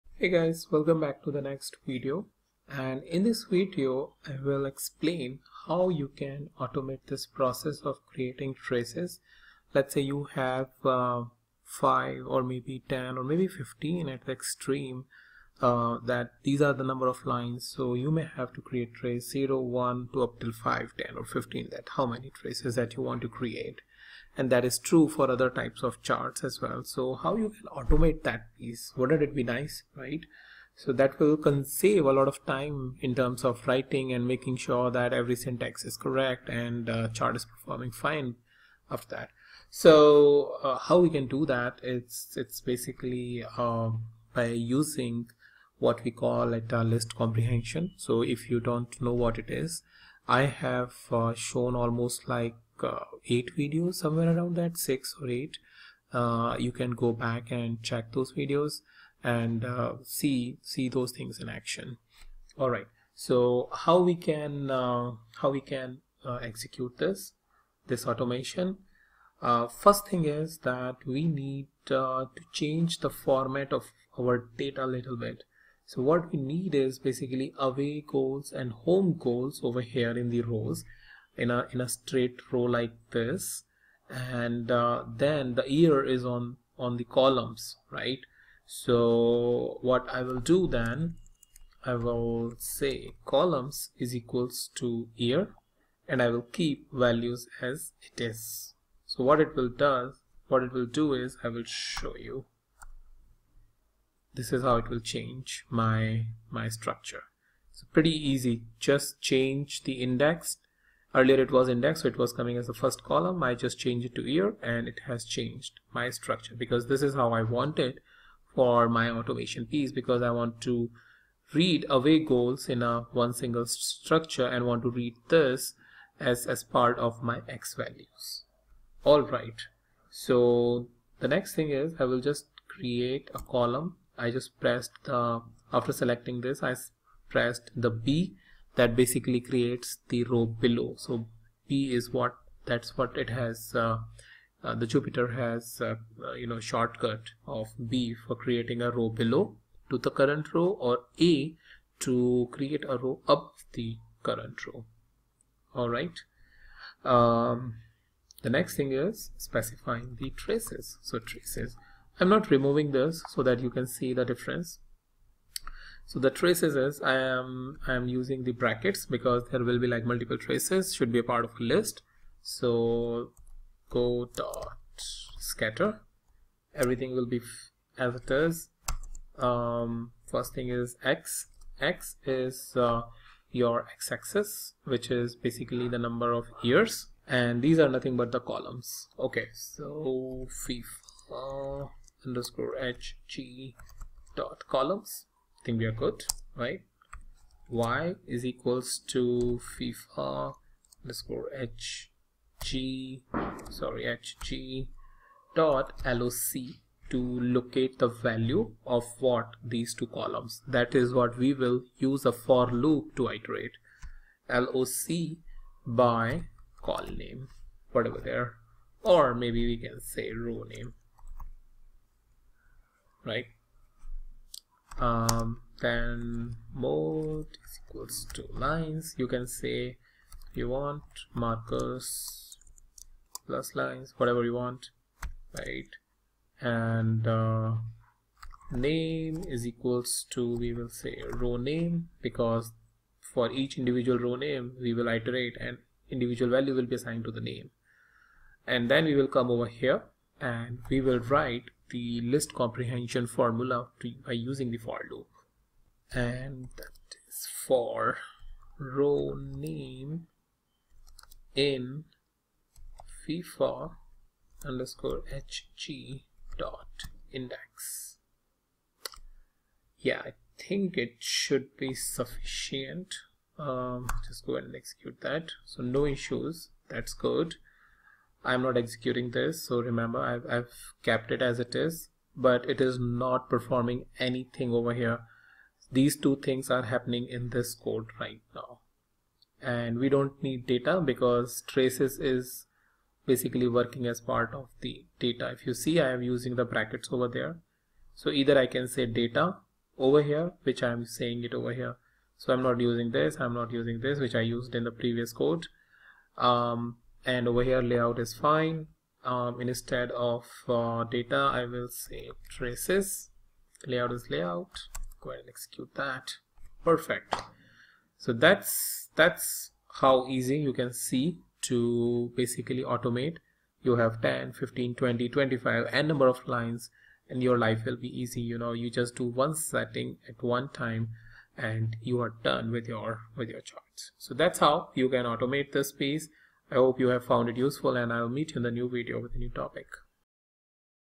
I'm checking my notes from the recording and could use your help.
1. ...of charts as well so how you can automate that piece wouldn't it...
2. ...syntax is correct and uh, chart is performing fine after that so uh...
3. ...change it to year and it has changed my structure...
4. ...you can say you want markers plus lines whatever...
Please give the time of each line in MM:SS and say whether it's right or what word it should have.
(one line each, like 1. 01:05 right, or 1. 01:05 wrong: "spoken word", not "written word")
1. 00:25 right
2. 00:35 right
3. 01:53 right
4. 03:49 right.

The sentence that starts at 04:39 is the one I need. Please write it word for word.
So remember, I've, I've kept it as it is, but it is not performing anything over here.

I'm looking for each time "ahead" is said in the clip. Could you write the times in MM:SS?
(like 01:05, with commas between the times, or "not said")
04:34, 05:15.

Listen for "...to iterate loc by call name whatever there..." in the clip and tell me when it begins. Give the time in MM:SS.
03:33.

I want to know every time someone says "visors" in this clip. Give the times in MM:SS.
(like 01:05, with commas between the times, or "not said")
not said.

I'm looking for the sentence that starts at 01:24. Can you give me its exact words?
And uh, then the year is on, on the columns, right?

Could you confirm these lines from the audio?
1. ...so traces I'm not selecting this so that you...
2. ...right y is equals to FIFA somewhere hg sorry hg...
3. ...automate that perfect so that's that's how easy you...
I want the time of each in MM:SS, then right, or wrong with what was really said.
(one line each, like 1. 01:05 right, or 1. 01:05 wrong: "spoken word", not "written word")
1. 02:41 wrong: "removing", not "selecting"
2. 03:16 wrong: "underscore", not "somewhere"
3. 05:15 wrong: "execute", not "automate".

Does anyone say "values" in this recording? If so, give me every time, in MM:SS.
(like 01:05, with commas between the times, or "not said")
01:36, 02:07, 03:28, 04:06.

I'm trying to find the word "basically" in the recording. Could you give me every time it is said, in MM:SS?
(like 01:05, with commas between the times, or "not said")
00:42, 01:16, 02:18, 03:05, 04:53, 05:22.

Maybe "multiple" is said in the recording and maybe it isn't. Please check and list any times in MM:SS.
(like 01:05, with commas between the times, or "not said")
02:50.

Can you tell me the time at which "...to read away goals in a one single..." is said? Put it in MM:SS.
02:00.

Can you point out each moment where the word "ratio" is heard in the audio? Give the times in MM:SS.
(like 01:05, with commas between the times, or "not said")
not said.